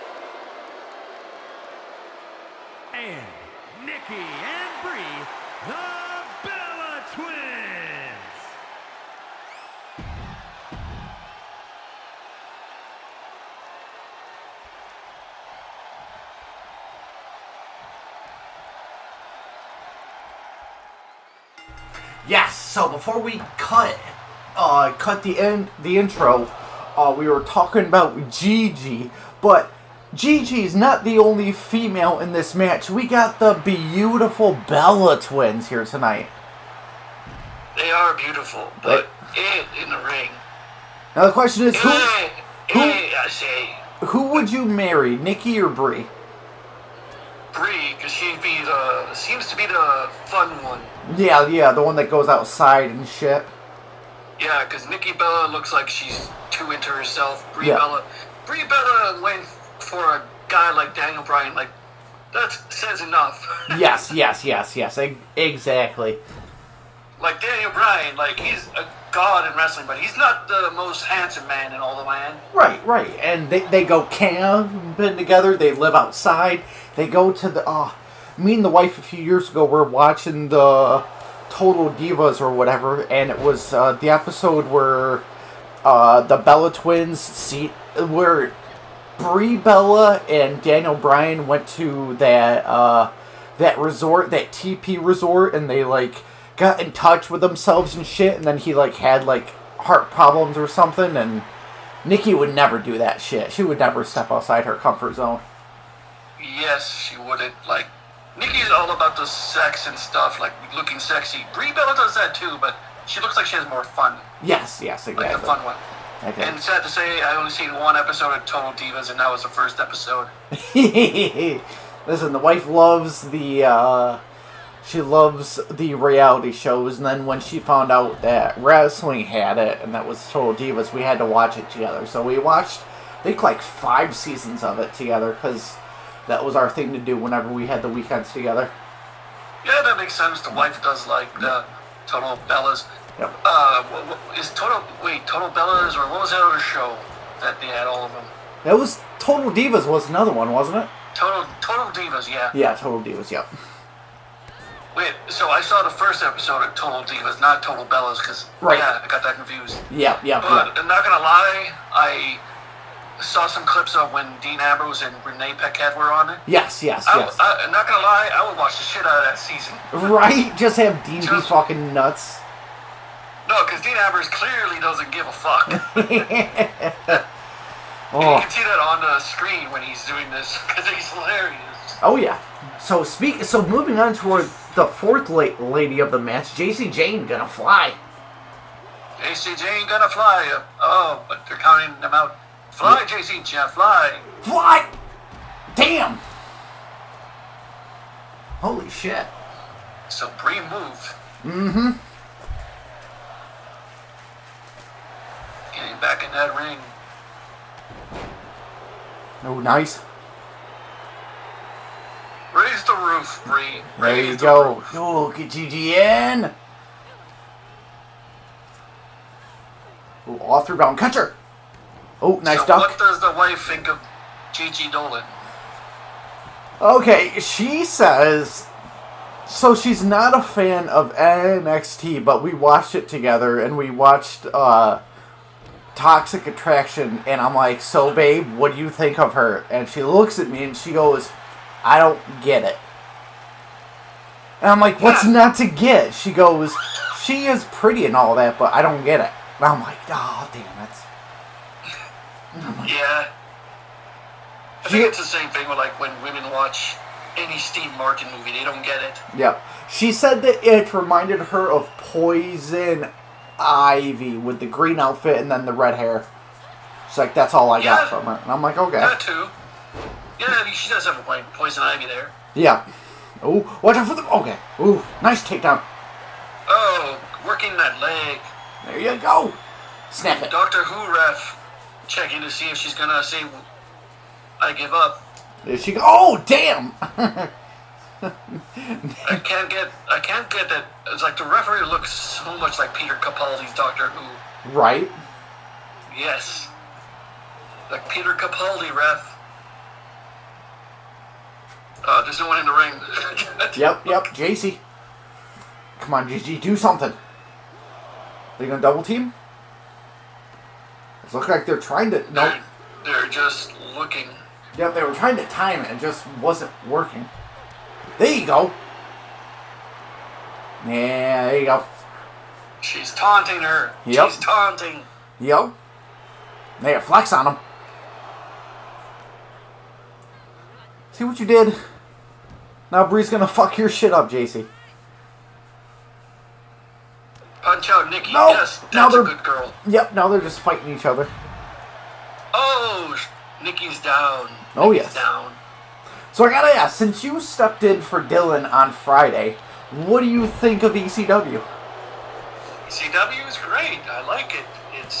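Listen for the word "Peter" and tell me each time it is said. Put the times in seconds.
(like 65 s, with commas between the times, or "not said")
292 s, 298 s.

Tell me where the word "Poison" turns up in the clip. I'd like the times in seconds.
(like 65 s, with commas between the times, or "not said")
261 s, 271 s.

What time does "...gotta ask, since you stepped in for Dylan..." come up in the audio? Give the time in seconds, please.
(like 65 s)
346 s.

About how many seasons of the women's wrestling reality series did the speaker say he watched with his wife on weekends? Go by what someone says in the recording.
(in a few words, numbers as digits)
5.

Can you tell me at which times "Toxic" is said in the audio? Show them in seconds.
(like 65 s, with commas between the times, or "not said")
235 s.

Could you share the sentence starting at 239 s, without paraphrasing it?
And she looks at me and she goes, I don't get it.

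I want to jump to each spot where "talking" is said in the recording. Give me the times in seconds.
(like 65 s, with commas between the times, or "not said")
27 s.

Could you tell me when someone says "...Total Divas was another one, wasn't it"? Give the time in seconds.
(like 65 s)
149 s.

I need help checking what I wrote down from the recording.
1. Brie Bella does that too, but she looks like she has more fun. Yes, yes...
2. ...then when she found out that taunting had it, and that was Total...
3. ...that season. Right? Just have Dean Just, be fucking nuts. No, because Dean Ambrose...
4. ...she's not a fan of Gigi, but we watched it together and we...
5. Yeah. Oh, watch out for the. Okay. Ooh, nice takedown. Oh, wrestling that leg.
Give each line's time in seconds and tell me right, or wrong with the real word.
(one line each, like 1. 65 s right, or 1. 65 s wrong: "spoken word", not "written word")
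1. 111 s right
2. 127 s wrong: "wrestling", not "taunting"
3. 169 s right
4. 229 s wrong: "NXT", not "Gigi"
5. 272 s wrong: "working", not "wrestling".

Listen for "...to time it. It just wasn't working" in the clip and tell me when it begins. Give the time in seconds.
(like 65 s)
315 s.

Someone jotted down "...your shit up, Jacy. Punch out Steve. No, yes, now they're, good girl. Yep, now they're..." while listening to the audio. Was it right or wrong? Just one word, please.
wrong.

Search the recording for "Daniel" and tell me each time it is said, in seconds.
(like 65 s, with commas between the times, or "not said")
60 s, 67 s, 90 s.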